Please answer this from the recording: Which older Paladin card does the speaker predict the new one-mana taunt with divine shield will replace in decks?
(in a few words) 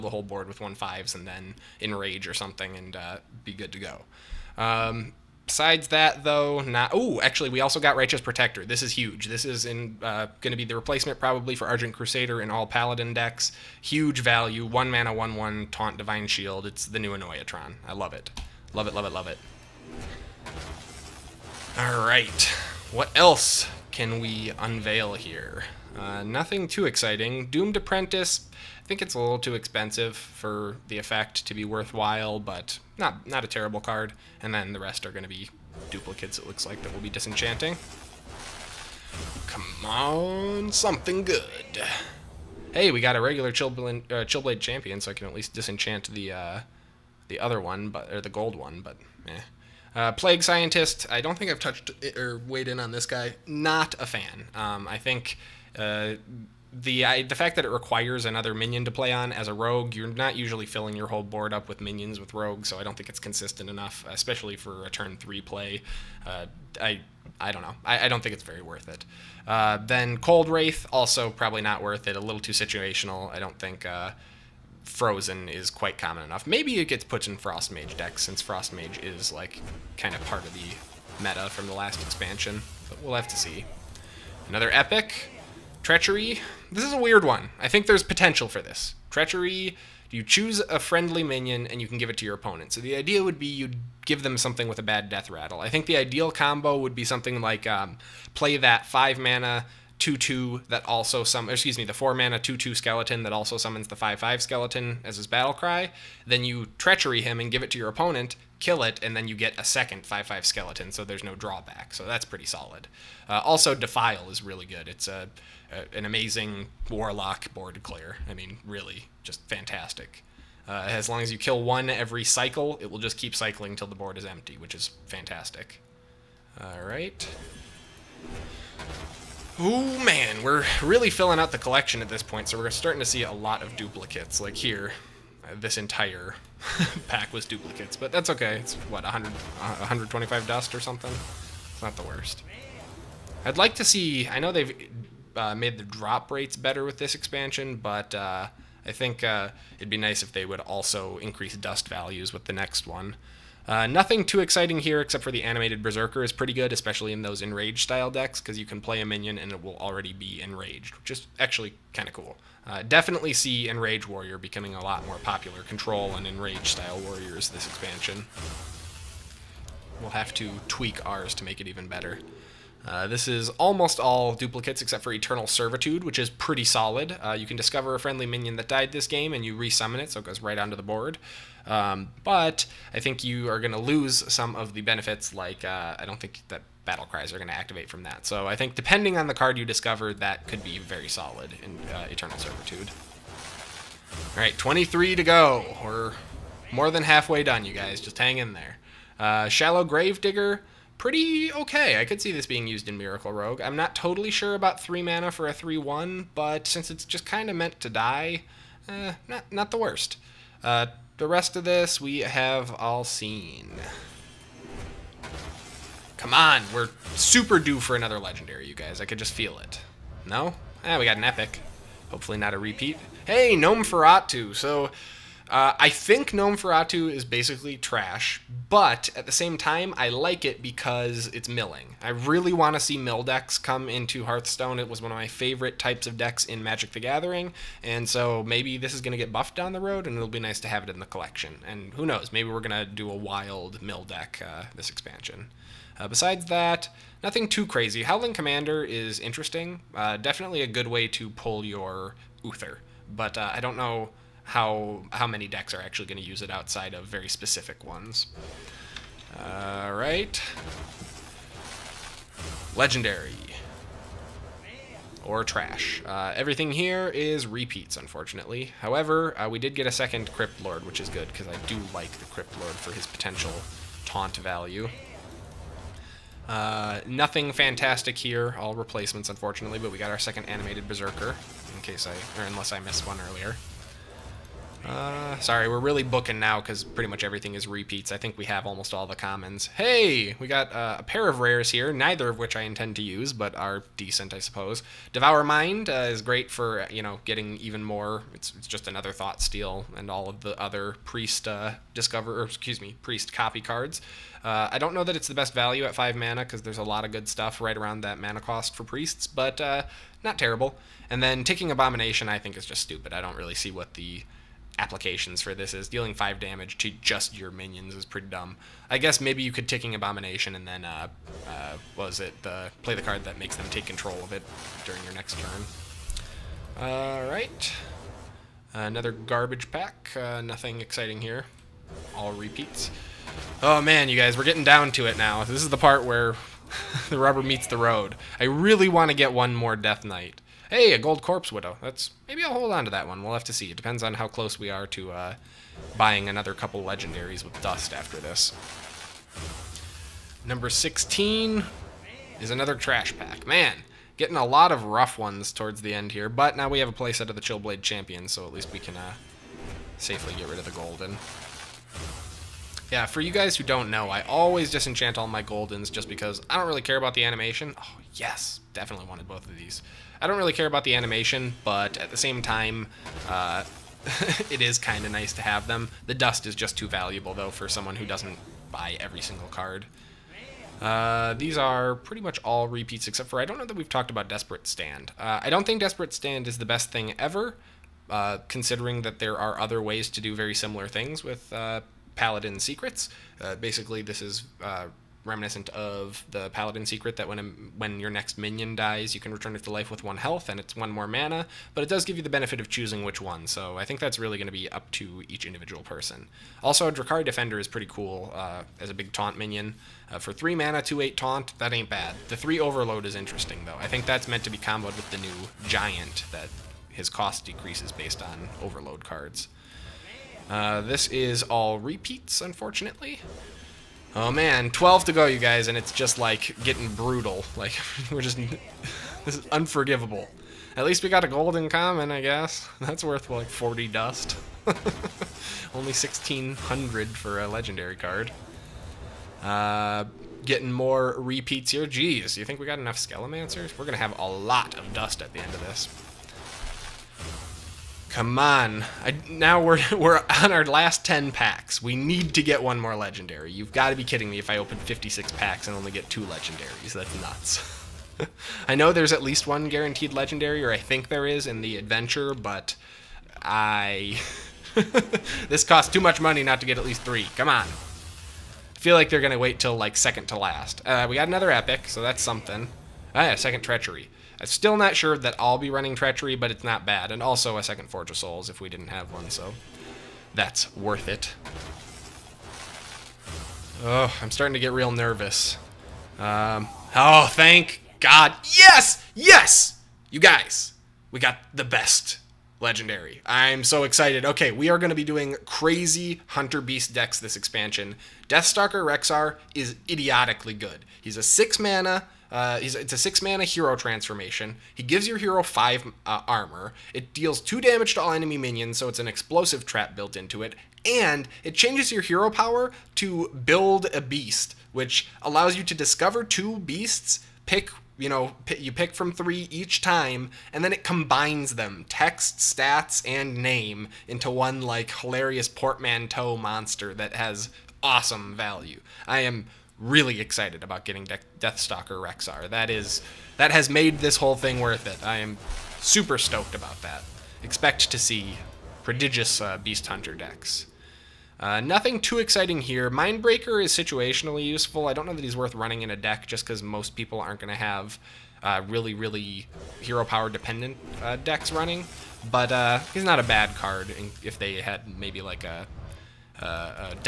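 Argent Crusader.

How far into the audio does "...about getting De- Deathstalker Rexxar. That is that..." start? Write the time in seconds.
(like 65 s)
530 s.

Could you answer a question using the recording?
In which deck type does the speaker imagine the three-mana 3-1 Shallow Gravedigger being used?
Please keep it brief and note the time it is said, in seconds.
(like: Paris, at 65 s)
Miracle Rogue, at 202 s.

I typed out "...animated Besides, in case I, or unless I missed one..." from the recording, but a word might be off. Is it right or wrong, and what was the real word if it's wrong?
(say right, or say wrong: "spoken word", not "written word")
wrong: "Berserker", not "Besides".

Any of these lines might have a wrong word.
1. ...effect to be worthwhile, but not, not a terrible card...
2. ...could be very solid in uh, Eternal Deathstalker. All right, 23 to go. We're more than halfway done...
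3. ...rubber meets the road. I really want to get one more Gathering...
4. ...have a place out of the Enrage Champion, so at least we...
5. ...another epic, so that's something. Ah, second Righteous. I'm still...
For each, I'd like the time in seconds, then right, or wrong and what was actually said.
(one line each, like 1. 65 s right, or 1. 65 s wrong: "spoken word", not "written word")
1. 30 s right
2. 190 s wrong: "Servitude", not "Deathstalker"
3. 337 s wrong: "Death", not "Gathering"
4. 356 s wrong: "Chillblade", not "Enrage"
5. 471 s wrong: "Treachery", not "Righteous".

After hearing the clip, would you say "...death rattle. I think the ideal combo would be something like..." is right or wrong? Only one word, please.
right.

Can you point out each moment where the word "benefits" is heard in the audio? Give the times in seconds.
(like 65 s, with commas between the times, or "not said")
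184 s, 402 s.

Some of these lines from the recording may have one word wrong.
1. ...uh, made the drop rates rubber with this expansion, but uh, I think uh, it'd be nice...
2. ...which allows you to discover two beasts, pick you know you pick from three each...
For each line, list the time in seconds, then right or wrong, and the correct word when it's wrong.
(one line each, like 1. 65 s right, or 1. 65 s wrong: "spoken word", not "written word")
1. 145 s wrong: "better", not "rubber"
2. 514 s right.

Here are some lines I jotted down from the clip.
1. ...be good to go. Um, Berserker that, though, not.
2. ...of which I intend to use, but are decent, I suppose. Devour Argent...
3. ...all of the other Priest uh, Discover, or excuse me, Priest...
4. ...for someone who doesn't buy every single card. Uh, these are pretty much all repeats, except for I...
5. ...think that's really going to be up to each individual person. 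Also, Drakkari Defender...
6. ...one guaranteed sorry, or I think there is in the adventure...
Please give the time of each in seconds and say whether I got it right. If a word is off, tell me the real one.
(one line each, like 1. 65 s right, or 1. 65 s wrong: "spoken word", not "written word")
1. 3 s wrong: "Besides", not "Berserker"
2. 292 s wrong: "Mind", not "Argent"
3. 300 s right
4. 377 s right
5. 403 s right
6. 459 s wrong: "legendary", not "sorry".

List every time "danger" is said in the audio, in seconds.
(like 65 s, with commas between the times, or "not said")
not said.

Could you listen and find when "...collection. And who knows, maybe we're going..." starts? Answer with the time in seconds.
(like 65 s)
241 s.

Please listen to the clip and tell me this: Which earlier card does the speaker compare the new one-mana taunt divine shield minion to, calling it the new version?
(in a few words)
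Annoyatron.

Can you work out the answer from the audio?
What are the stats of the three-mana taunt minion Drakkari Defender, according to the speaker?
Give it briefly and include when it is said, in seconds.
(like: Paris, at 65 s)
2/8, at 410 s.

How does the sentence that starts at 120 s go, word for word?
Uh, as long as you kill one every cycle, it will just keep cycling till the board is empty, which is fantastic.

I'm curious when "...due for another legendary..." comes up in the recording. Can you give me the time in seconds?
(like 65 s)
217 s.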